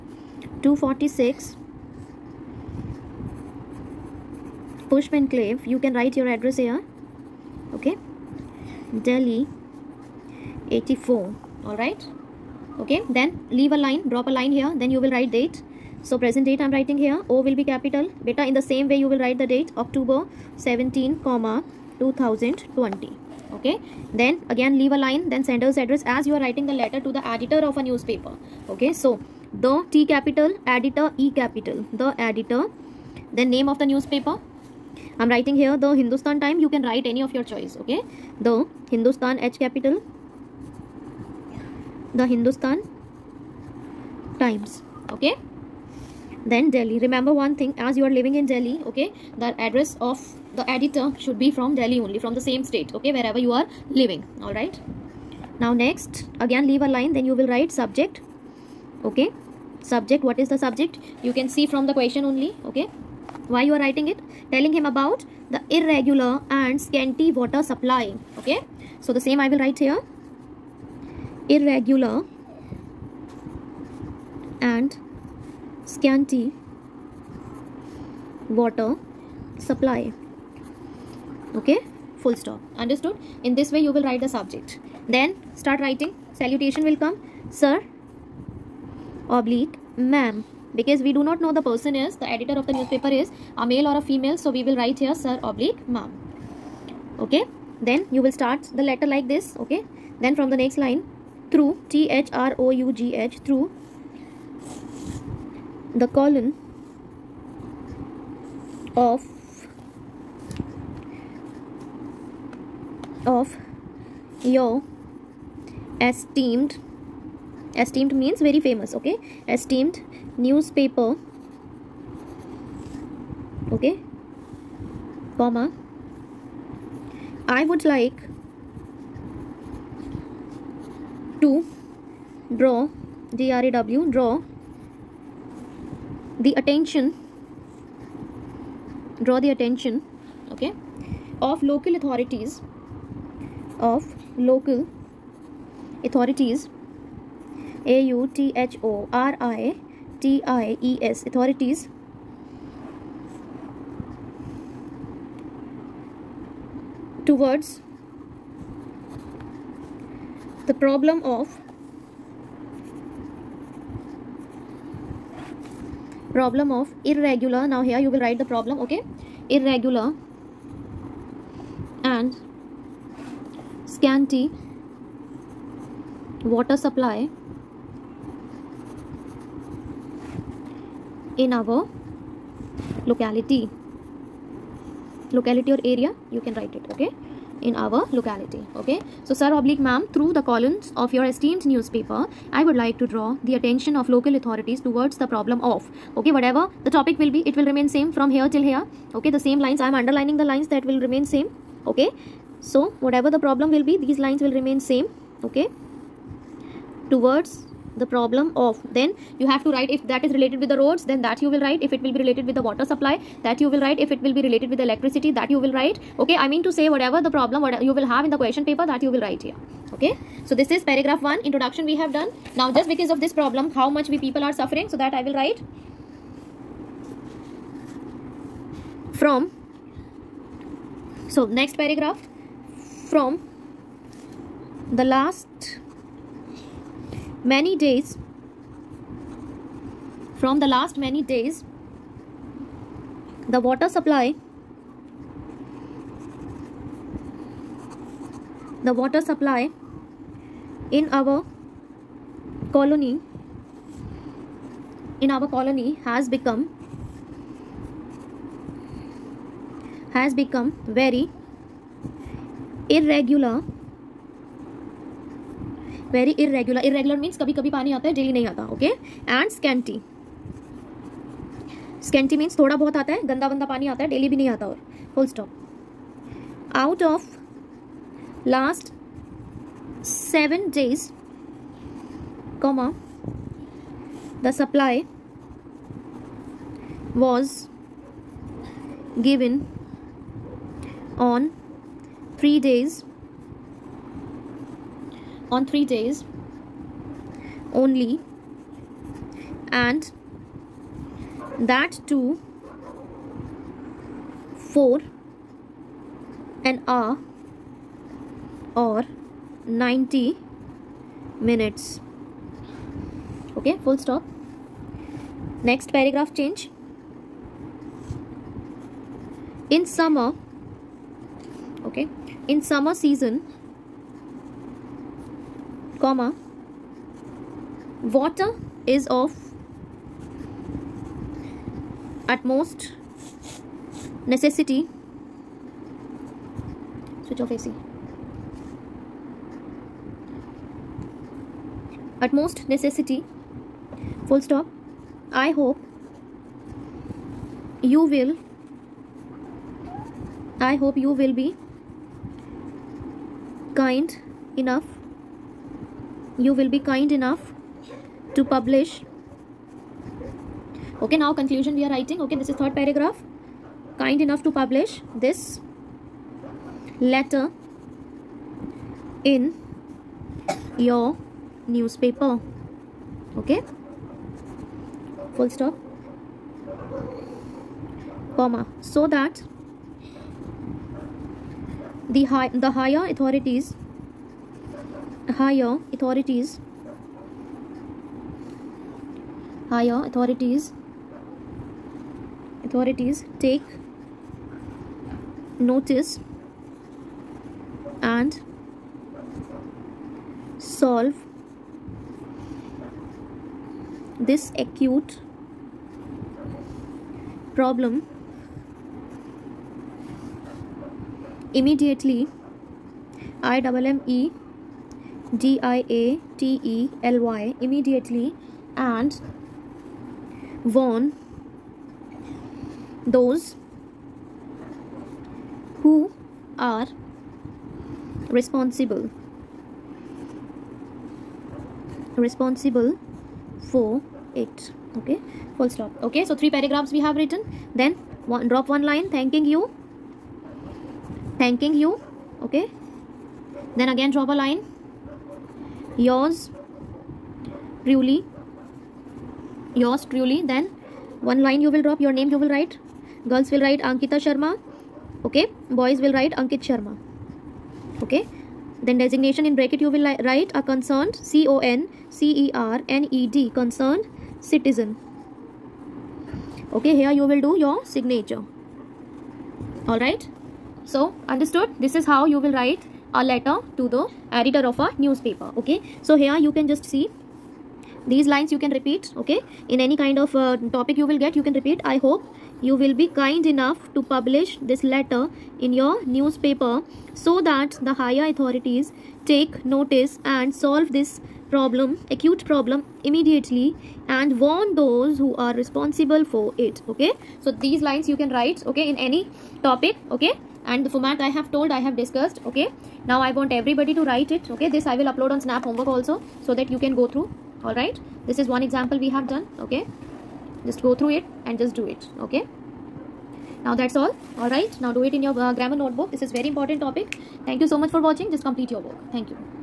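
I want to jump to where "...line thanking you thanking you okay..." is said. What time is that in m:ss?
7:18.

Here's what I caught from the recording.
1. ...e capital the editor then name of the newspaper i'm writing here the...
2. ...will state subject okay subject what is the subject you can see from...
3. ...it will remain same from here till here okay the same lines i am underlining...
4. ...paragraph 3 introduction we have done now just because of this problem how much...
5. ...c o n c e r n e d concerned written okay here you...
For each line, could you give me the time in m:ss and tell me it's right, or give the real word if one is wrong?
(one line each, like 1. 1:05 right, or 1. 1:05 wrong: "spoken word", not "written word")
1. 0:31 right
2. 0:57 wrong: "write", not "state"
3. 3:17 right
4. 3:40 wrong: "1", not "3"
5. 7:41 wrong: "citizen", not "written".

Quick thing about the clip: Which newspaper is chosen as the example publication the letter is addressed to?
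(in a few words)
The Hindustan Times.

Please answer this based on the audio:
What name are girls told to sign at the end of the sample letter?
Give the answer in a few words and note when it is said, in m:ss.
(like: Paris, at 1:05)
Ankita Sharma, at 7:33.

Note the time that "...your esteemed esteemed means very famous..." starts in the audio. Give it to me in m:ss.
1:54.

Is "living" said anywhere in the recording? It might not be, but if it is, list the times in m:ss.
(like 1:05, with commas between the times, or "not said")
0:48, 0:53.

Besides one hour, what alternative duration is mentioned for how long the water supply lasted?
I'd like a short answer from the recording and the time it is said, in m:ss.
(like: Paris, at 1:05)
90 minutes, at 5:09.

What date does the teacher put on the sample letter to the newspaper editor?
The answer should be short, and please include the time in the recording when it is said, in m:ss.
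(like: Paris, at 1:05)
October 17, 2020, at 0:19.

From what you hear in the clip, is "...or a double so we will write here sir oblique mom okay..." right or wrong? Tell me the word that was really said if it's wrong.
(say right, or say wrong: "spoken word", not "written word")
wrong: "female", not "double".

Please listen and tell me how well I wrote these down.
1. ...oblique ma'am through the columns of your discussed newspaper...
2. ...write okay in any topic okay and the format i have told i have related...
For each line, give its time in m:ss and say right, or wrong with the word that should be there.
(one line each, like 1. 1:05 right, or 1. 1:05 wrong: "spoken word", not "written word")
1. 3:09 wrong: "esteemed", not "discussed"
2. 8:18 wrong: "discussed", not "related".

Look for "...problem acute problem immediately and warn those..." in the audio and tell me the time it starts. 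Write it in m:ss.
8:11.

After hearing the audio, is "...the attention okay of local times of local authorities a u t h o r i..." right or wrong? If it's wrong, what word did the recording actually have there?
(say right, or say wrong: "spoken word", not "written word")
wrong: "authorities", not "times".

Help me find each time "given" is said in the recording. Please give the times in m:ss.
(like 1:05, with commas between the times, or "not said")
4:49.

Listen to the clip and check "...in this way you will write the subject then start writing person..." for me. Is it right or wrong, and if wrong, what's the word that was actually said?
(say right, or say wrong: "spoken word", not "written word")
wrong: "salutation", not "person".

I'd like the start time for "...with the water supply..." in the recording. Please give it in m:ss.
3:32.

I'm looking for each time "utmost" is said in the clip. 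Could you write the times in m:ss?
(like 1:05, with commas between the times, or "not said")
5:32, 5:42.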